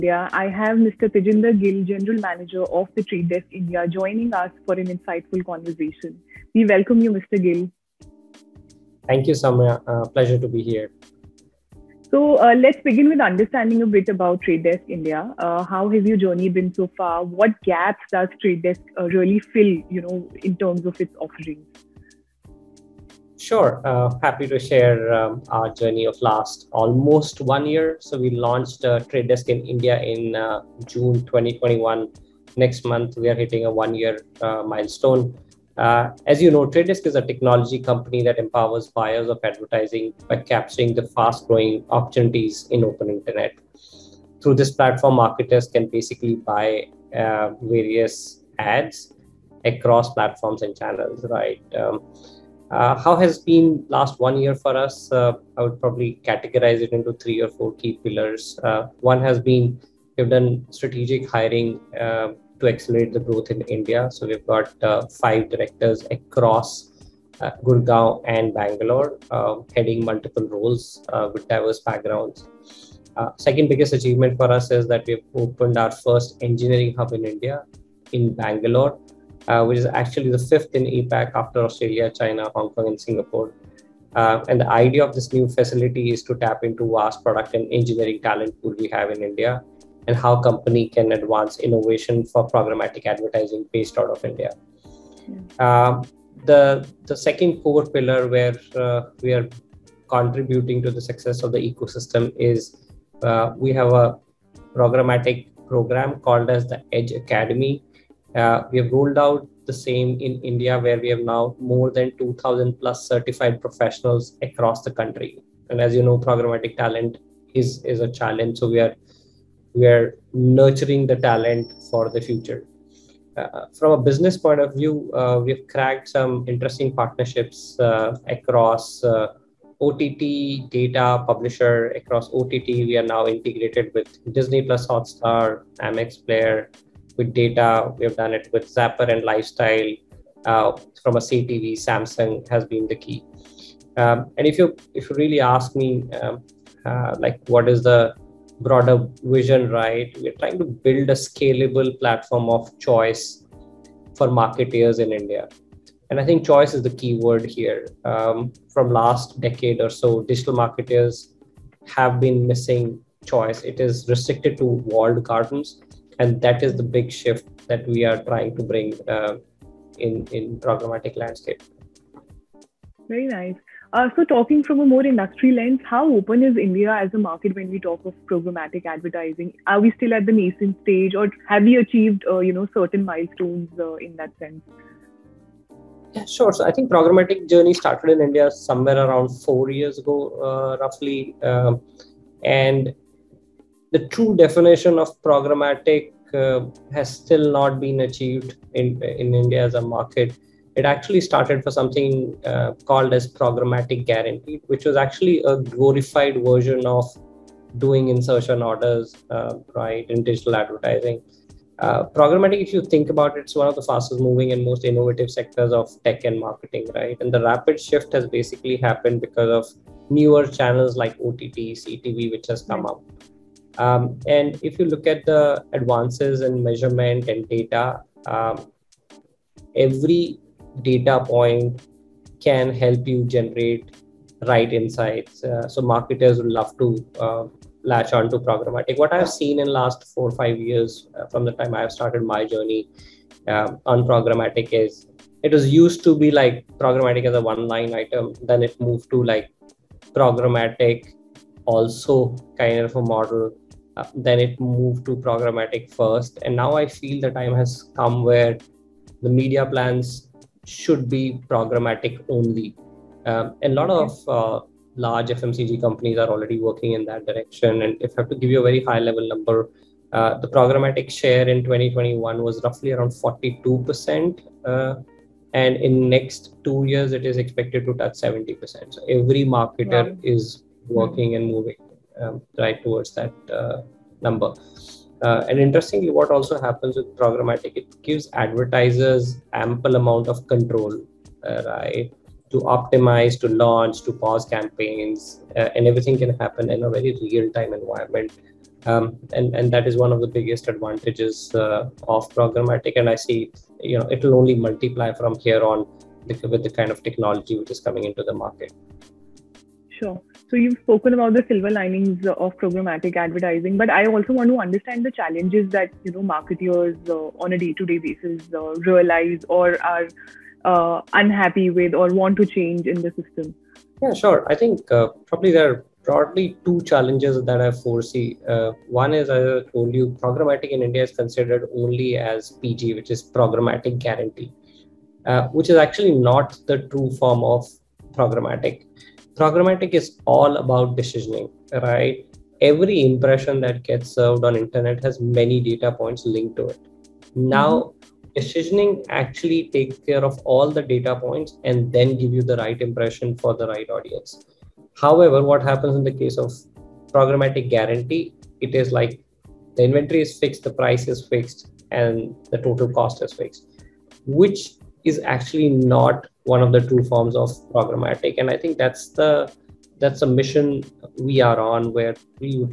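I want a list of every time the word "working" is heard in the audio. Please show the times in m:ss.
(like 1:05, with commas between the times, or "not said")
4:26, 4:40.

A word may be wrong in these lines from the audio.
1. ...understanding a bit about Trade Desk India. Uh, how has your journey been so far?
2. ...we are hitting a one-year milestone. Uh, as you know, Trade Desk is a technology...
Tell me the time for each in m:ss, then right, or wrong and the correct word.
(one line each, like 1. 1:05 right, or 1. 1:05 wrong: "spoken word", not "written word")
1. 0:13 right
2. 0:33 right.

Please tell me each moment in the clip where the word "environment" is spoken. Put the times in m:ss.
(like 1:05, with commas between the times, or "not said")
4:57.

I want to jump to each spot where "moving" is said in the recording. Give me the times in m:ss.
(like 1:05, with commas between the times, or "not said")
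3:34, 4:41.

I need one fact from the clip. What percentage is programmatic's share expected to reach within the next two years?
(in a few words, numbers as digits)
70%.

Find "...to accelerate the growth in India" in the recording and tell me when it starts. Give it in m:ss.
1:02.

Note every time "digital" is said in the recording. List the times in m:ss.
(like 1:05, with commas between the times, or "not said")
2:40, 3:30.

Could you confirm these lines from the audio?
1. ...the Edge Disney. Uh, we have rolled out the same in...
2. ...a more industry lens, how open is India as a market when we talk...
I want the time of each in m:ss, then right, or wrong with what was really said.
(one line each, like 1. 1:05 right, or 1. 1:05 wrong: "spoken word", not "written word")
1. 1:46 wrong: "Academy", not "Disney"
2. 2:54 right.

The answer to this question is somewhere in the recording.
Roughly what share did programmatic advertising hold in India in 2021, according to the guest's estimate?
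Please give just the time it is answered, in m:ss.
4:33.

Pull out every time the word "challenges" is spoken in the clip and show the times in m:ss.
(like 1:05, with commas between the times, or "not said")
1:58, 5:15, 5:26.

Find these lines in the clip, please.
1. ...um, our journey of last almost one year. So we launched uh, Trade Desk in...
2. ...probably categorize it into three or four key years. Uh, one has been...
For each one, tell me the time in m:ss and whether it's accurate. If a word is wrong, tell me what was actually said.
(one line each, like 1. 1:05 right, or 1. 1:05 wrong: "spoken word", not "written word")
1. 0:25 right
2. 0:55 wrong: "pillars", not "years".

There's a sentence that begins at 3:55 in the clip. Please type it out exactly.
Uh, so marketers would love to uh, latch on to programmatic.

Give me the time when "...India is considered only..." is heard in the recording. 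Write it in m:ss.
5:30.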